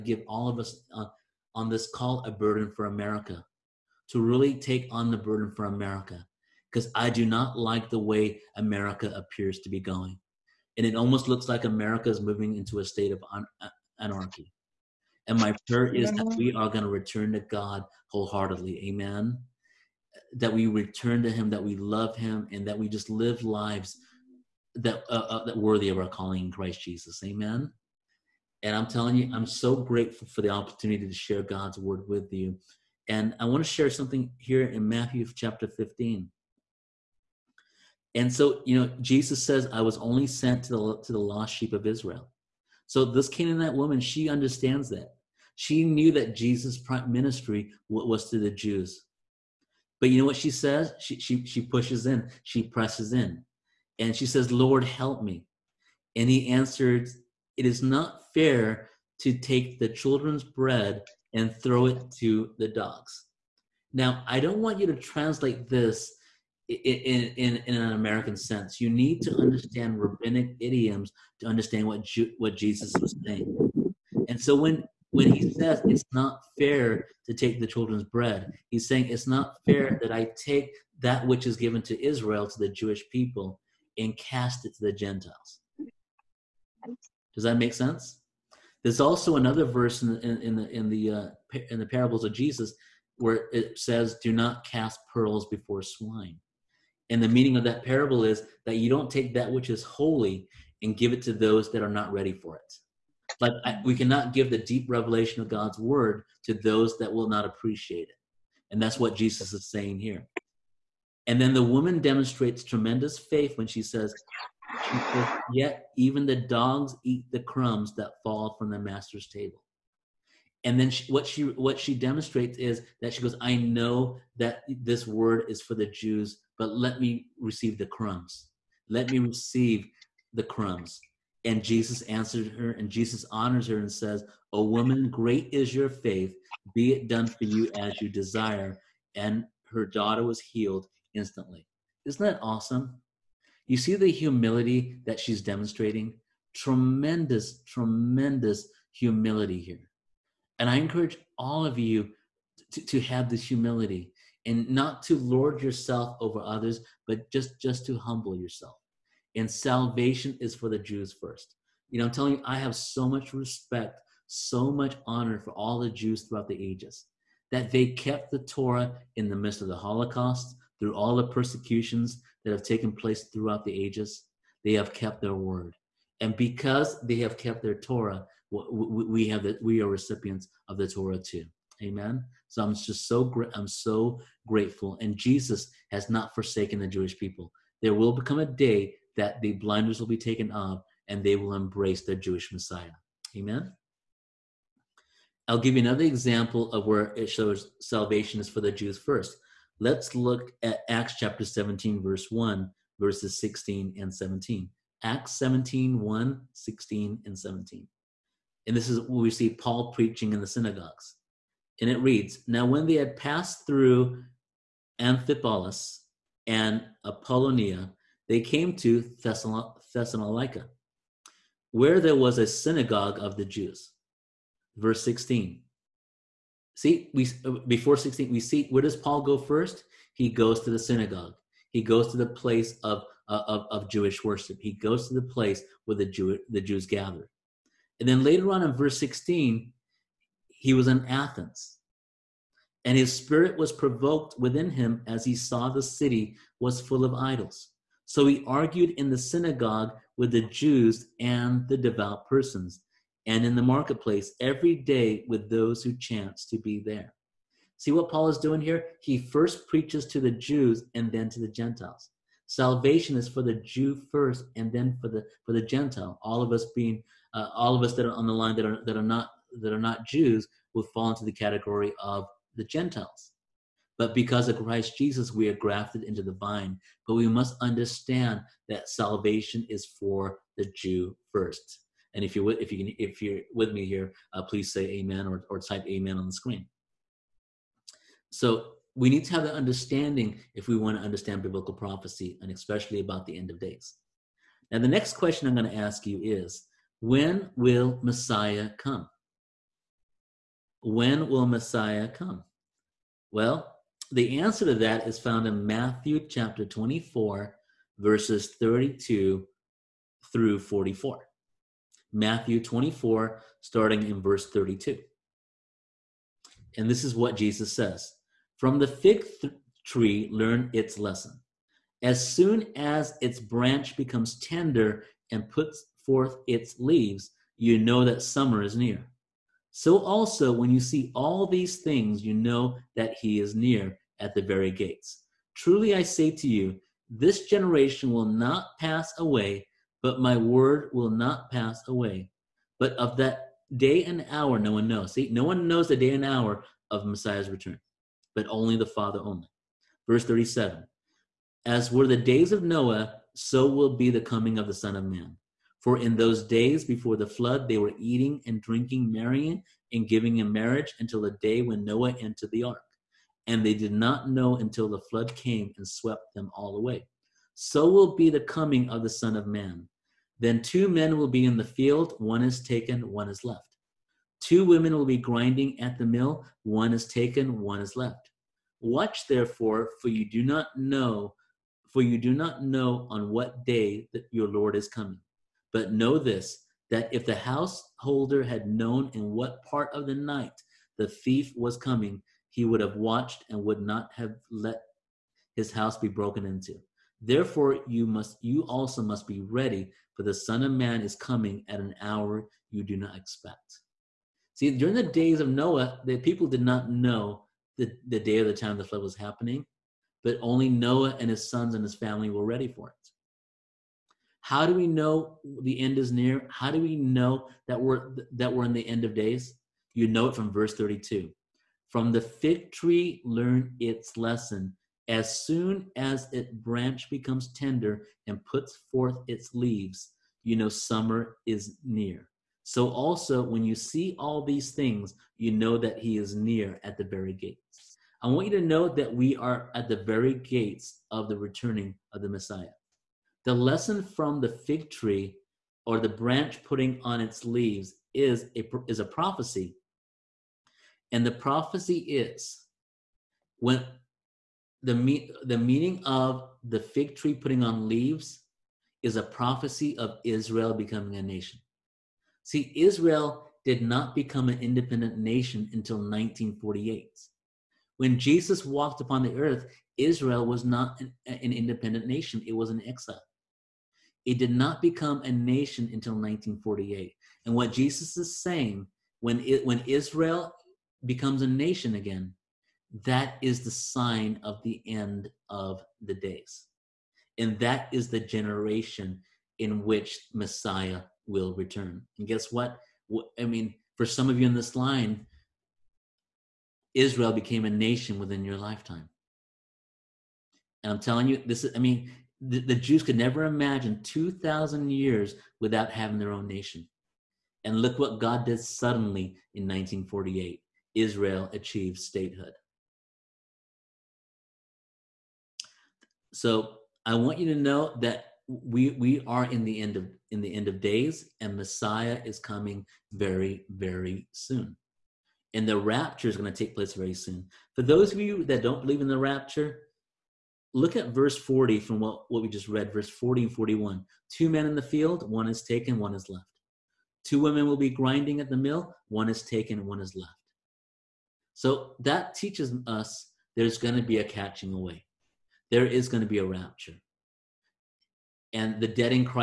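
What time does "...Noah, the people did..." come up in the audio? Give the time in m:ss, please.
6:45.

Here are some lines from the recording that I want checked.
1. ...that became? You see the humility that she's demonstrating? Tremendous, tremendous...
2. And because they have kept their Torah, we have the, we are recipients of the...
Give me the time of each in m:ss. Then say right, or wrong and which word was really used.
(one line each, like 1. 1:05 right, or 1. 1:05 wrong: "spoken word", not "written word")
1. 2:22 wrong: "awesome", not "became"
2. 2:56 right.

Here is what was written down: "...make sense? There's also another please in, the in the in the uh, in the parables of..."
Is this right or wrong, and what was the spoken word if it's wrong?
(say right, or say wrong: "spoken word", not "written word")
wrong: "verse", not "please".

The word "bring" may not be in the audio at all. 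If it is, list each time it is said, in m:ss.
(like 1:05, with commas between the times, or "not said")
not said.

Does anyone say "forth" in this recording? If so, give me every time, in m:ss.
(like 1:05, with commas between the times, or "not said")
5:26, 7:08.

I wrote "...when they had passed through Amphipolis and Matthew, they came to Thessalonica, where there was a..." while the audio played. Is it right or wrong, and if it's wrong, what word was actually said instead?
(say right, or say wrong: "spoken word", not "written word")
wrong: "Apollonia", not "Matthew".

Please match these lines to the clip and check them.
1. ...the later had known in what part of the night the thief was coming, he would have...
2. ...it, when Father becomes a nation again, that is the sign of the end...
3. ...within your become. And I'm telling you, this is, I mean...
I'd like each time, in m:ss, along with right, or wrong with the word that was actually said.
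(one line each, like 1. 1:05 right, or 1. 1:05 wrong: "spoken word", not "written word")
1. 6:27 wrong: "householder", not "later"
2. 7:59 wrong: "Israel", not "Father"
3. 8:18 wrong: "lifetime", not "become".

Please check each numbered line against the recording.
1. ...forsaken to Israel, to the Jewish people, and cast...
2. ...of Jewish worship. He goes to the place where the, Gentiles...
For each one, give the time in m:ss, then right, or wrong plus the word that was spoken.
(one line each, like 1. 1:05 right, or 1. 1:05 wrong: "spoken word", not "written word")
1. 1:21 wrong: "given", not "forsaken"
2. 3:53 wrong: "Jew", not "Gentiles".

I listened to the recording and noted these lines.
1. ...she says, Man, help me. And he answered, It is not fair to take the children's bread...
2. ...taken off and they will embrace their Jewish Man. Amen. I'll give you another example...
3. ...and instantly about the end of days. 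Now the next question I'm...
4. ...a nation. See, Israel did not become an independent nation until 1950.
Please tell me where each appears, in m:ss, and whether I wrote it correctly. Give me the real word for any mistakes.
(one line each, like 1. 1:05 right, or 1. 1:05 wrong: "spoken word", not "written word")
1. 0:54 wrong: "Lord", not "Man"
2. 3:10 wrong: "Messiah", not "Man"
3. 4:52 wrong: "especially", not "instantly"
4. 7:41 wrong: "1948", not "1950".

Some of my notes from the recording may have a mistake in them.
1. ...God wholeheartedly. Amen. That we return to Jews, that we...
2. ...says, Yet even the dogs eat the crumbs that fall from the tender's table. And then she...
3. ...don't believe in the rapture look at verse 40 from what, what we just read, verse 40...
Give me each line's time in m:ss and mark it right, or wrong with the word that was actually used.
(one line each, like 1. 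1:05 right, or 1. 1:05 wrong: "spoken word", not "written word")
1. 0:17 wrong: "Him", not "Jews"
2. 1:54 wrong: "master", not "tender"
3. 8:48 right.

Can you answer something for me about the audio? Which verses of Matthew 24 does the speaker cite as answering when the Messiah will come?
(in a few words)
32 through 44.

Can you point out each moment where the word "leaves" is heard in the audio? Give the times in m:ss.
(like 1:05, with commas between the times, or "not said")
5:26, 7:09, 7:27, 7:37.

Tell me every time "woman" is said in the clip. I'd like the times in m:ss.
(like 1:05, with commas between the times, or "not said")
0:43, 1:51, 2:14.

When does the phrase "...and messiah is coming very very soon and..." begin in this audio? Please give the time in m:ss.
8:41.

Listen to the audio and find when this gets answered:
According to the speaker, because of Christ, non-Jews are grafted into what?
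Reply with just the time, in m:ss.
4:36.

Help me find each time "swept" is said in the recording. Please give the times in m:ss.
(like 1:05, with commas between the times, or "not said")
6:05.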